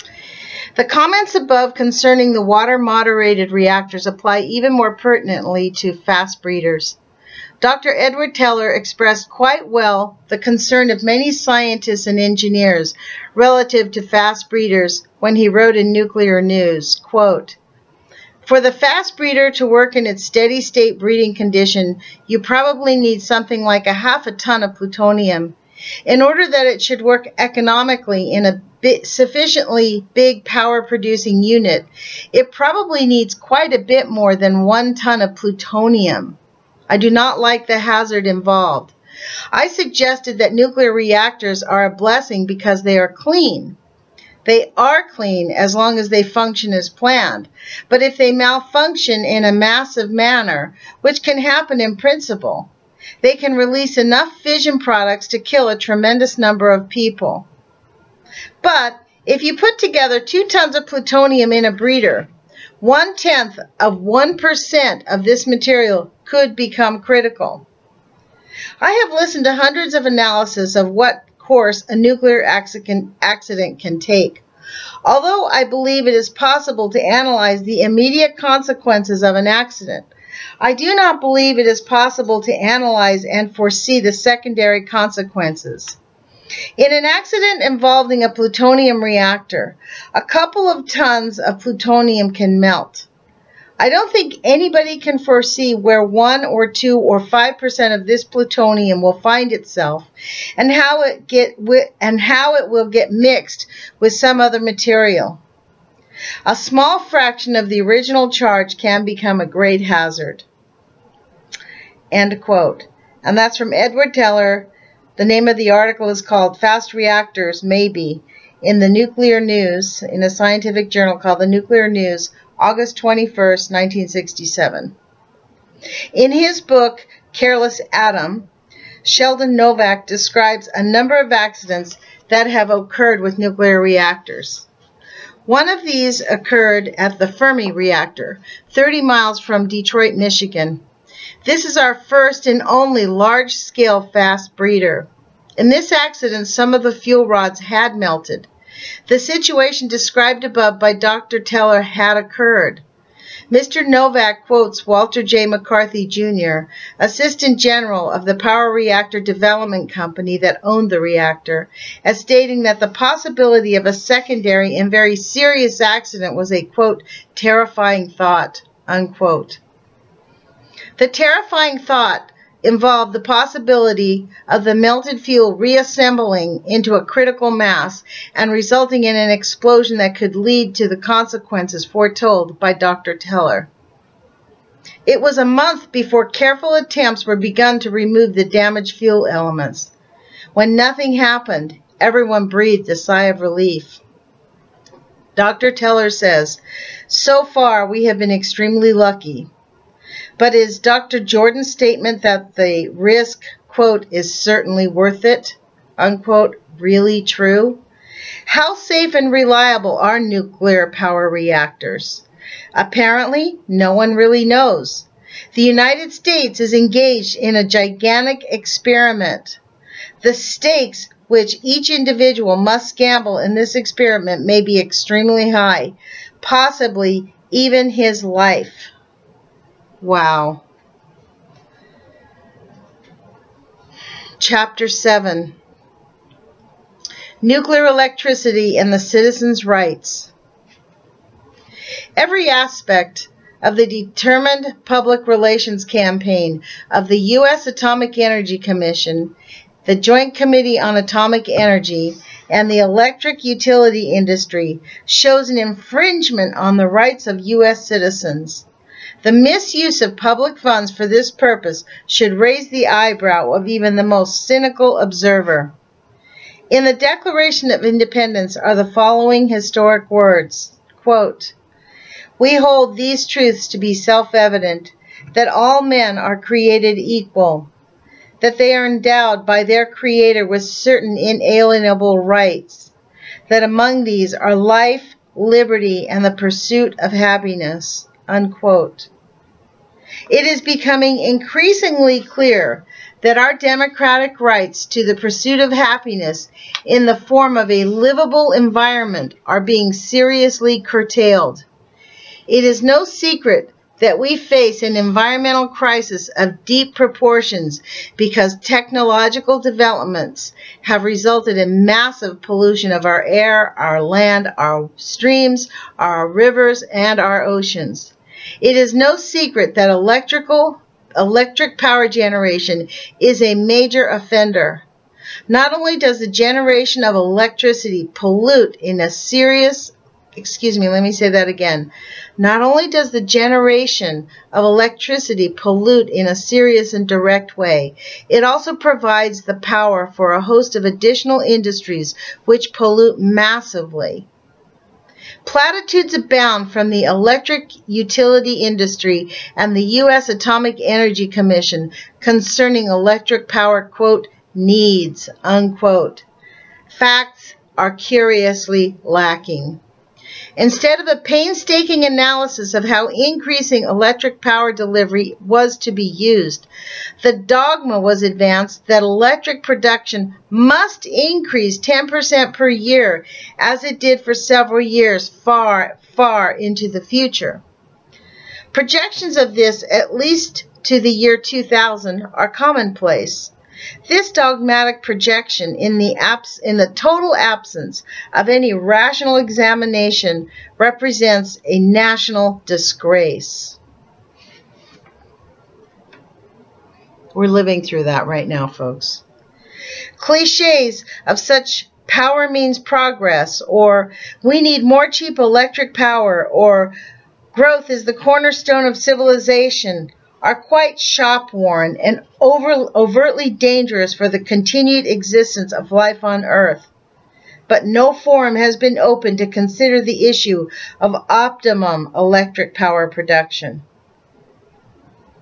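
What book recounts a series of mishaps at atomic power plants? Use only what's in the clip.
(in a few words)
Careless Atom.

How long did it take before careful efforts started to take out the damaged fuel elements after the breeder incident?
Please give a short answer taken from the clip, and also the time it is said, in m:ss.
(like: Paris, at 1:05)
a month, at 3:05.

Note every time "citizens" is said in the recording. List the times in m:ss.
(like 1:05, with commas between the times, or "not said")
3:58, 4:17.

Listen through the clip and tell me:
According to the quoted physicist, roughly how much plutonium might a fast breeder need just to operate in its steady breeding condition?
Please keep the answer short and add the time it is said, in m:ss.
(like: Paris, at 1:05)
half a ton, at 0:23.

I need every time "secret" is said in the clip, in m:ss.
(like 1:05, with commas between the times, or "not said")
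5:03, 5:19.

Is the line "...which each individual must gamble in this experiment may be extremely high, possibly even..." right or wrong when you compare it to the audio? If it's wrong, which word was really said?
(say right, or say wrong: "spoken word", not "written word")
right.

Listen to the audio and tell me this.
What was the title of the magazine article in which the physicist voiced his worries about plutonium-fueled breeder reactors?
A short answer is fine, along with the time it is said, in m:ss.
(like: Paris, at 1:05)
Fast Reactors Maybe, at 1:56.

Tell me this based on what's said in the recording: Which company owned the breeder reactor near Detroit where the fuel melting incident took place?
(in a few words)
Power Reactor Development Company.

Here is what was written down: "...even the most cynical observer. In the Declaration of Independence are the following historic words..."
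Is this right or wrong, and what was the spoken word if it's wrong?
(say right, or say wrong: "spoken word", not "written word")
right.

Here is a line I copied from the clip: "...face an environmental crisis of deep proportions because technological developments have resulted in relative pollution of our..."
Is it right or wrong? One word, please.
wrong.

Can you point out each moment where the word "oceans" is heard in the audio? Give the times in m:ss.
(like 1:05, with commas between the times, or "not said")
5:17.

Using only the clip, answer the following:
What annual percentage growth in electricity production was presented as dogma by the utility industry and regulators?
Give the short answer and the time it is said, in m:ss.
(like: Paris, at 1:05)
10%, at 6:11.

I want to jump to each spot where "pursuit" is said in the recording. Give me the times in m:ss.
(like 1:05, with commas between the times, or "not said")
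4:46, 4:55.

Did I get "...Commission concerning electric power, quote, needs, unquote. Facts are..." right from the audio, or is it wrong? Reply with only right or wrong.
right.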